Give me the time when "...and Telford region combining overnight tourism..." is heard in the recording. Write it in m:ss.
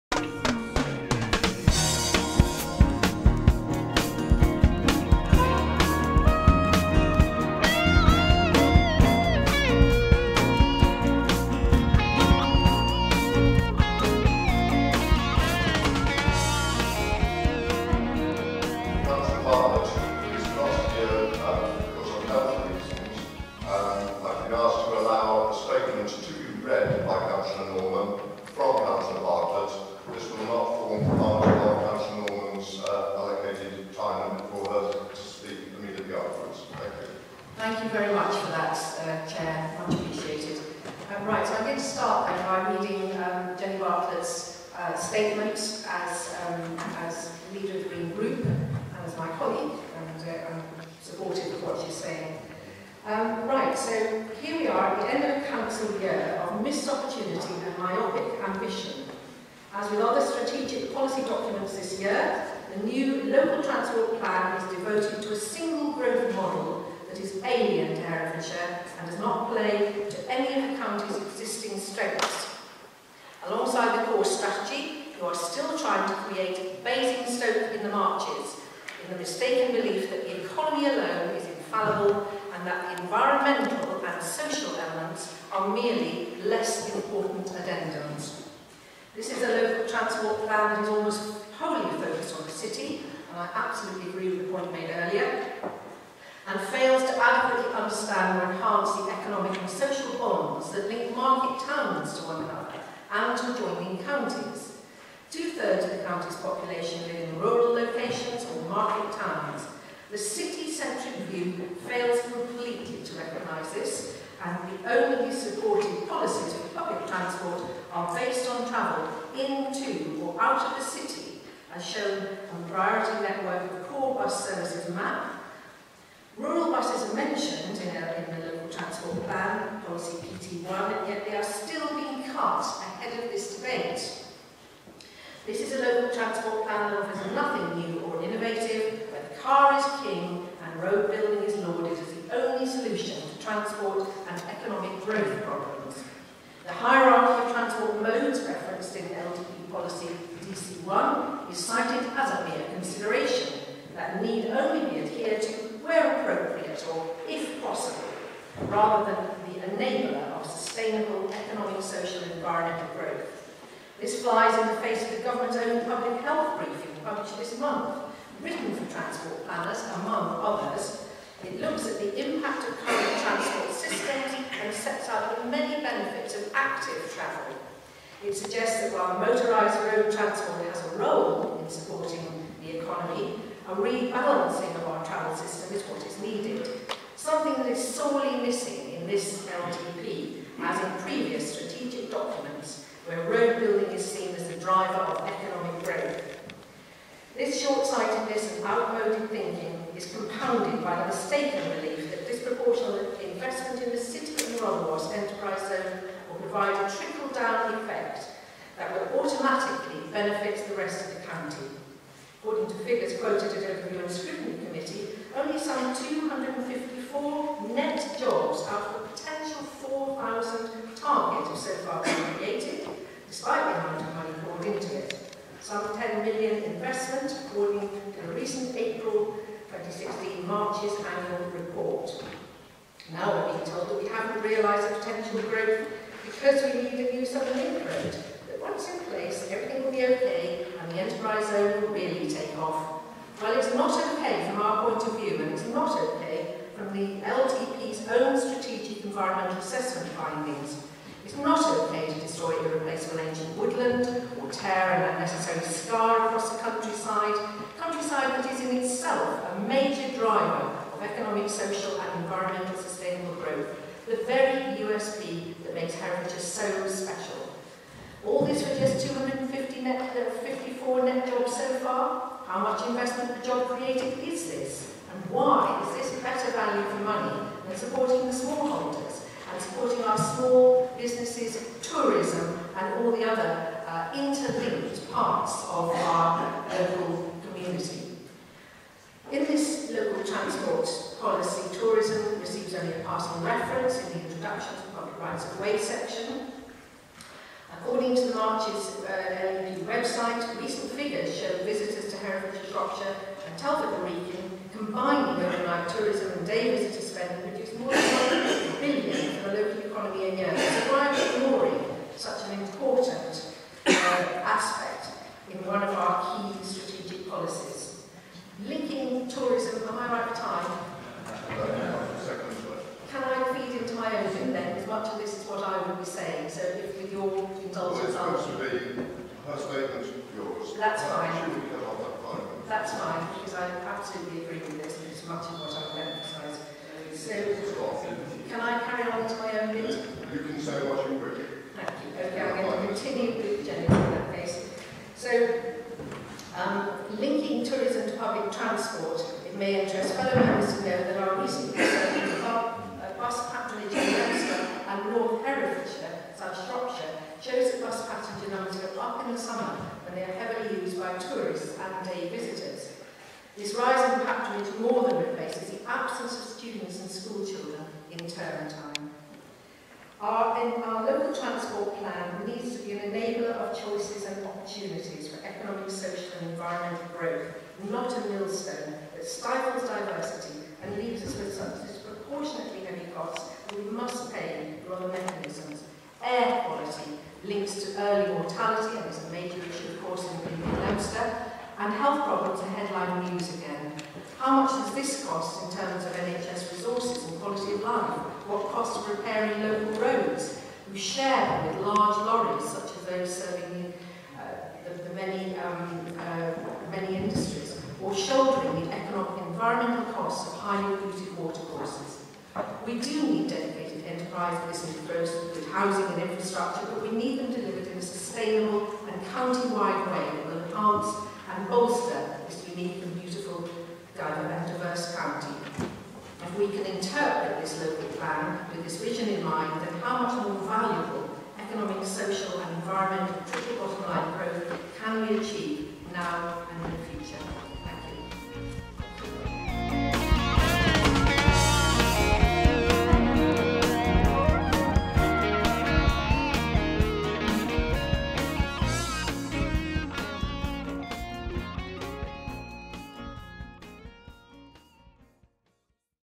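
5:03.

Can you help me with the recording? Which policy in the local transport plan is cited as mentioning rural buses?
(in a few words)
PT1.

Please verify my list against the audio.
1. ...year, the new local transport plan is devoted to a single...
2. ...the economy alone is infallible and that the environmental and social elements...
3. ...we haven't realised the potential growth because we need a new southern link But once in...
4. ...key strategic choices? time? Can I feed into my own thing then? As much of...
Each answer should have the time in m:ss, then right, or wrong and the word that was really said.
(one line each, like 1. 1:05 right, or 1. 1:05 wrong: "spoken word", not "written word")
1. 1:01 right
2. 1:20 right
3. 3:54 right
4. 5:16 wrong: "policies", not "choices".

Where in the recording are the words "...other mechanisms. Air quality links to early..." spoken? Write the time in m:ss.
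6:24.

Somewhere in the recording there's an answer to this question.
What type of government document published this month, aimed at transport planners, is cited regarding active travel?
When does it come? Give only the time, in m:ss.
2:45.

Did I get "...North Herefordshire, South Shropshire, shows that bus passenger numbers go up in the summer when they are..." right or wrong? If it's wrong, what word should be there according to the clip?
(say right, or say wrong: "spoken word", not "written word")
right.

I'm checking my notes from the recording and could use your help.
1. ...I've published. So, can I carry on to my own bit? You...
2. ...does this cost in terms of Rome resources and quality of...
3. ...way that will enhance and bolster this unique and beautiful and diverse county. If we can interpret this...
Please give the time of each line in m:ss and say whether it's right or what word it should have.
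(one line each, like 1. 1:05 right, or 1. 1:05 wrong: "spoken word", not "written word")
1. 5:35 wrong: "emphasised", not "published"
2. 6:34 wrong: "NHS", not "Rome"
3. 7:00 right.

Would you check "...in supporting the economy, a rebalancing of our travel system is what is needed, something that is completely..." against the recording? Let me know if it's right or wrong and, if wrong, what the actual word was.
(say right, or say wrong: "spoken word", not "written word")
wrong: "sorely", not "completely".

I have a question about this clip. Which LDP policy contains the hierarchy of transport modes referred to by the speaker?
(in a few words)
DC1.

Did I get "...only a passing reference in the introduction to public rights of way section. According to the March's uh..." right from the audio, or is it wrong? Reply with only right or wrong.
right.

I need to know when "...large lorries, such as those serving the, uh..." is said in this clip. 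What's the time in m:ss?
6:41.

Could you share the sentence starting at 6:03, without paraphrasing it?
This rise in patronage more than replaces the absence of students and schoolchildren in term time.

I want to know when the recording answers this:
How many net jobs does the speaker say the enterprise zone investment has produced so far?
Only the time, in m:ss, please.
4:30.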